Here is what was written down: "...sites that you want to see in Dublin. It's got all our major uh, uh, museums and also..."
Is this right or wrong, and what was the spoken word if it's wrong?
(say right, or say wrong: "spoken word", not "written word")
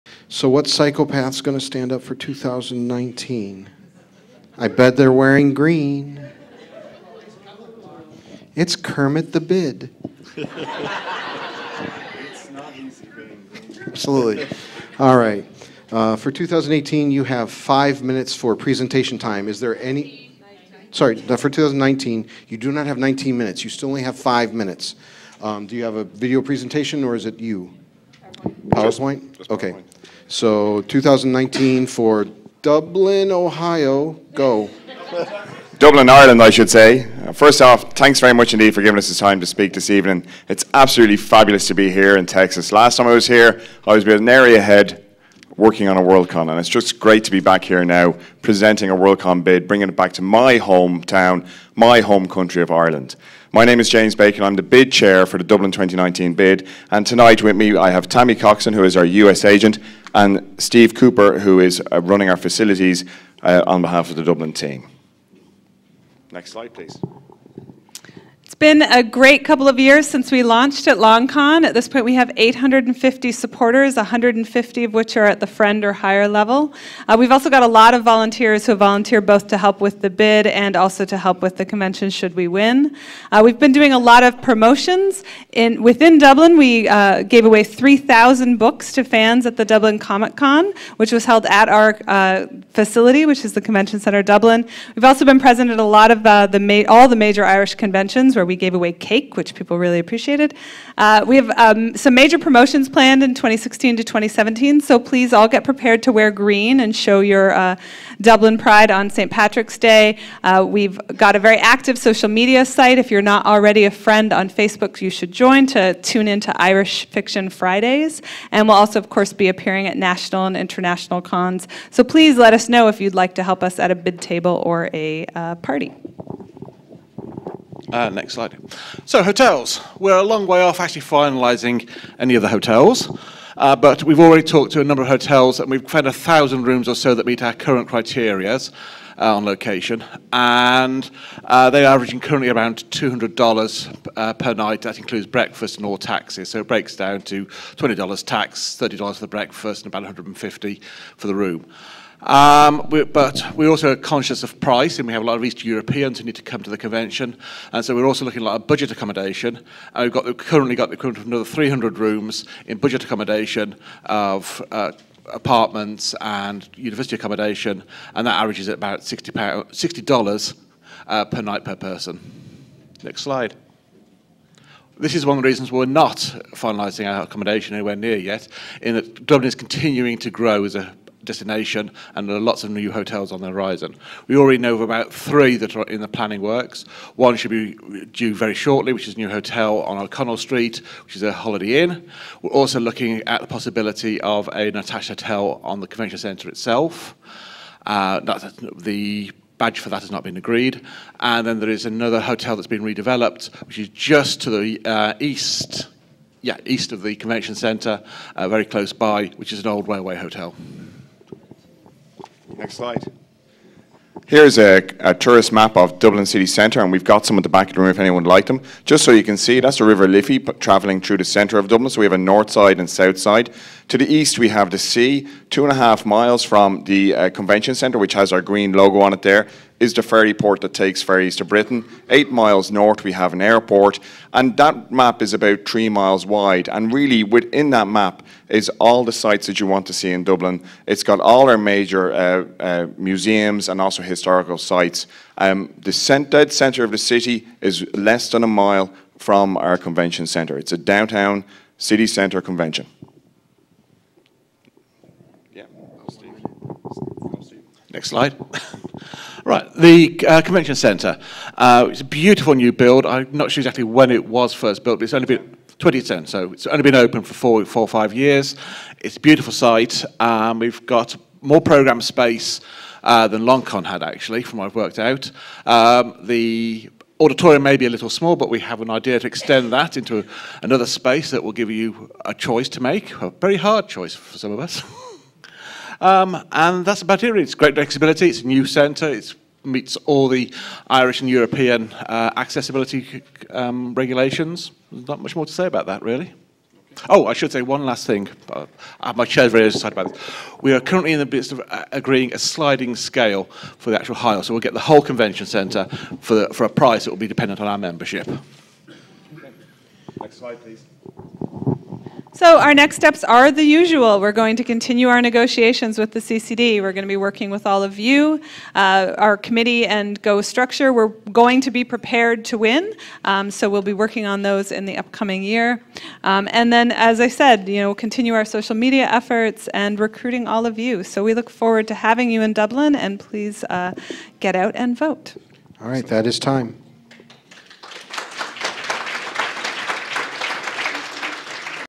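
right.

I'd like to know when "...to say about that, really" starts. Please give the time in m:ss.
4:55.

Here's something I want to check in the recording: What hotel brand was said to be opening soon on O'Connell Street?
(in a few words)
Holiday Inn.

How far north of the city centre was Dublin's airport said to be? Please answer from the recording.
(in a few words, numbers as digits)
8 miles.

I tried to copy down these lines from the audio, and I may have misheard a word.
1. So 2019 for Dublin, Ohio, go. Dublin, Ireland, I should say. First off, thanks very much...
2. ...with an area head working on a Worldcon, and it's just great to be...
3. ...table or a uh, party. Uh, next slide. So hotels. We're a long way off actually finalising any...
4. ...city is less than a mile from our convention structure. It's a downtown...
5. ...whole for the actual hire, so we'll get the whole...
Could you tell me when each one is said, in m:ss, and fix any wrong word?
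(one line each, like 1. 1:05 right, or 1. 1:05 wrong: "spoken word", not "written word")
1. 0:30 right
2. 0:44 right
3. 2:04 right
4. 4:06 wrong: "centre", not "structure"
5. 5:02 wrong: "scale", not "whole".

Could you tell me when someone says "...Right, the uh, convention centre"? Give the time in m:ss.
4:19.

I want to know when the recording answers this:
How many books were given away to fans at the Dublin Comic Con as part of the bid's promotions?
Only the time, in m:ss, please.
1:27.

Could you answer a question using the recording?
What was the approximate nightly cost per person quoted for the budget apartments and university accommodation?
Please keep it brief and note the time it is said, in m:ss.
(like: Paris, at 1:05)
$60, at 2:49.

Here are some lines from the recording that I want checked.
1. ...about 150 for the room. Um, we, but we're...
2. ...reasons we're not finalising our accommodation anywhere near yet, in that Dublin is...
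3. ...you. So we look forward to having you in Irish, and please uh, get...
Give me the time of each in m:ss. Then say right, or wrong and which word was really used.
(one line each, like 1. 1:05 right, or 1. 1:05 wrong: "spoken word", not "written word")
1. 2:29 right
2. 2:55 right
3. 5:30 wrong: "Dublin", not "Irish".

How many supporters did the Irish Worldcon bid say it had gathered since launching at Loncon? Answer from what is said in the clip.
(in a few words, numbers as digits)
850.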